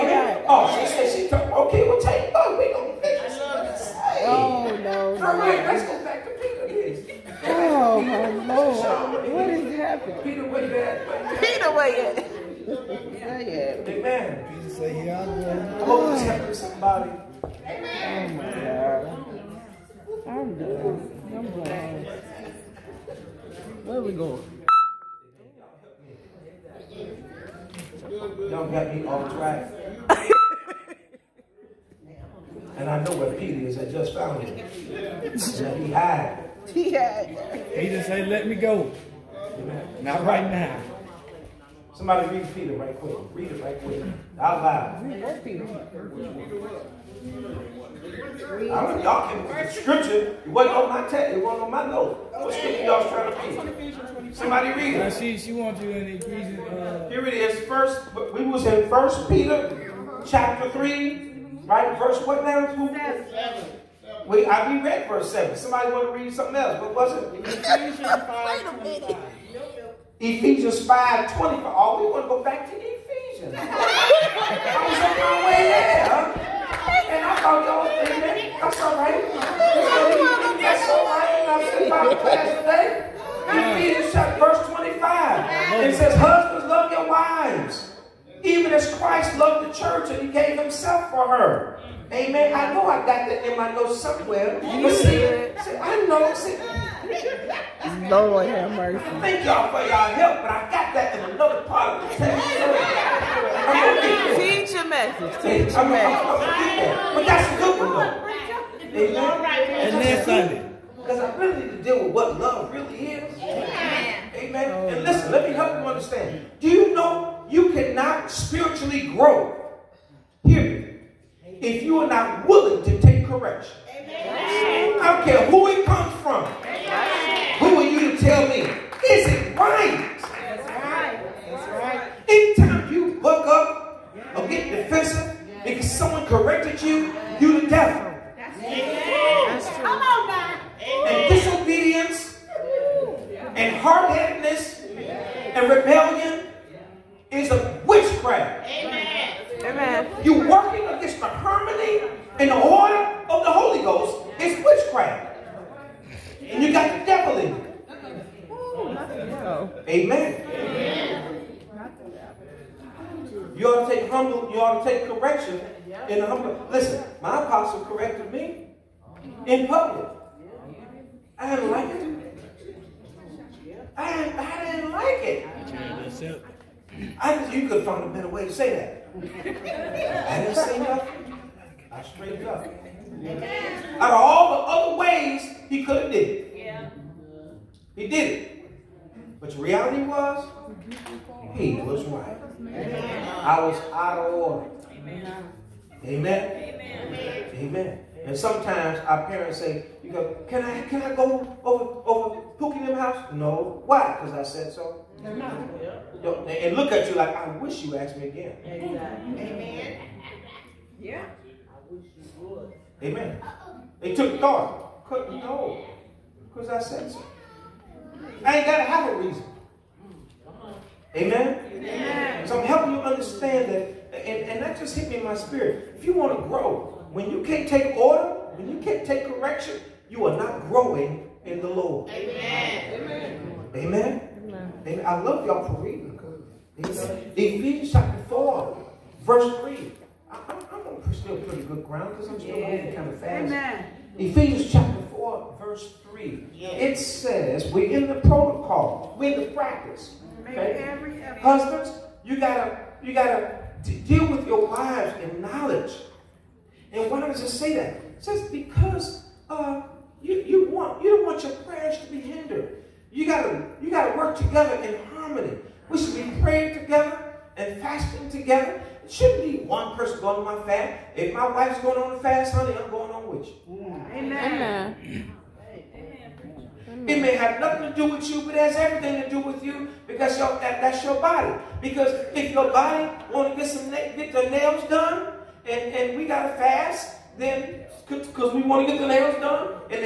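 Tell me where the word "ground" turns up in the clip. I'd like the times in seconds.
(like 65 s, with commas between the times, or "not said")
241 s.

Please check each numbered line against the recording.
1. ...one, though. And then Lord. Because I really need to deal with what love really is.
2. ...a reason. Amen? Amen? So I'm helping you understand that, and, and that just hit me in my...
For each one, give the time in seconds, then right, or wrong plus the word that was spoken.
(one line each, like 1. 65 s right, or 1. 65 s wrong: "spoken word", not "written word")
1. 107 s wrong: "Sunday", not "Lord"
2. 219 s right.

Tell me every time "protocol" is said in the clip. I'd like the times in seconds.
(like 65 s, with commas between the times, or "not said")
248 s.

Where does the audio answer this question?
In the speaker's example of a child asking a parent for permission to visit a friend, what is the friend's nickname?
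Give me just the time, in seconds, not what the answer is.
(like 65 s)
202 s.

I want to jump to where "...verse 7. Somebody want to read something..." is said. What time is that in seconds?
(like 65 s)
65 s.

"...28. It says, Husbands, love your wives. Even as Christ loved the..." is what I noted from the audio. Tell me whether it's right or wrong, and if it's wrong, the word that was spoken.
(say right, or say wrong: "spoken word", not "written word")
wrong: "25", not "28".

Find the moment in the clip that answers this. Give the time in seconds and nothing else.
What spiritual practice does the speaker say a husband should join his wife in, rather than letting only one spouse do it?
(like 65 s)
267 s.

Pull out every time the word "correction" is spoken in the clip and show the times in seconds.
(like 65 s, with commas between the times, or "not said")
123 s, 229 s.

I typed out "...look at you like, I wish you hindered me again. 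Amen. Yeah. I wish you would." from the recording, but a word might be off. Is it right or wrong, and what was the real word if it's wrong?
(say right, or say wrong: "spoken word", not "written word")
wrong: "asked", not "hindered".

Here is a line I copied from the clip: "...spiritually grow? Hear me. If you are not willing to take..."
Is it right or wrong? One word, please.
right.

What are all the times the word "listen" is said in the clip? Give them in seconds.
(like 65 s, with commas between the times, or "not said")
115 s.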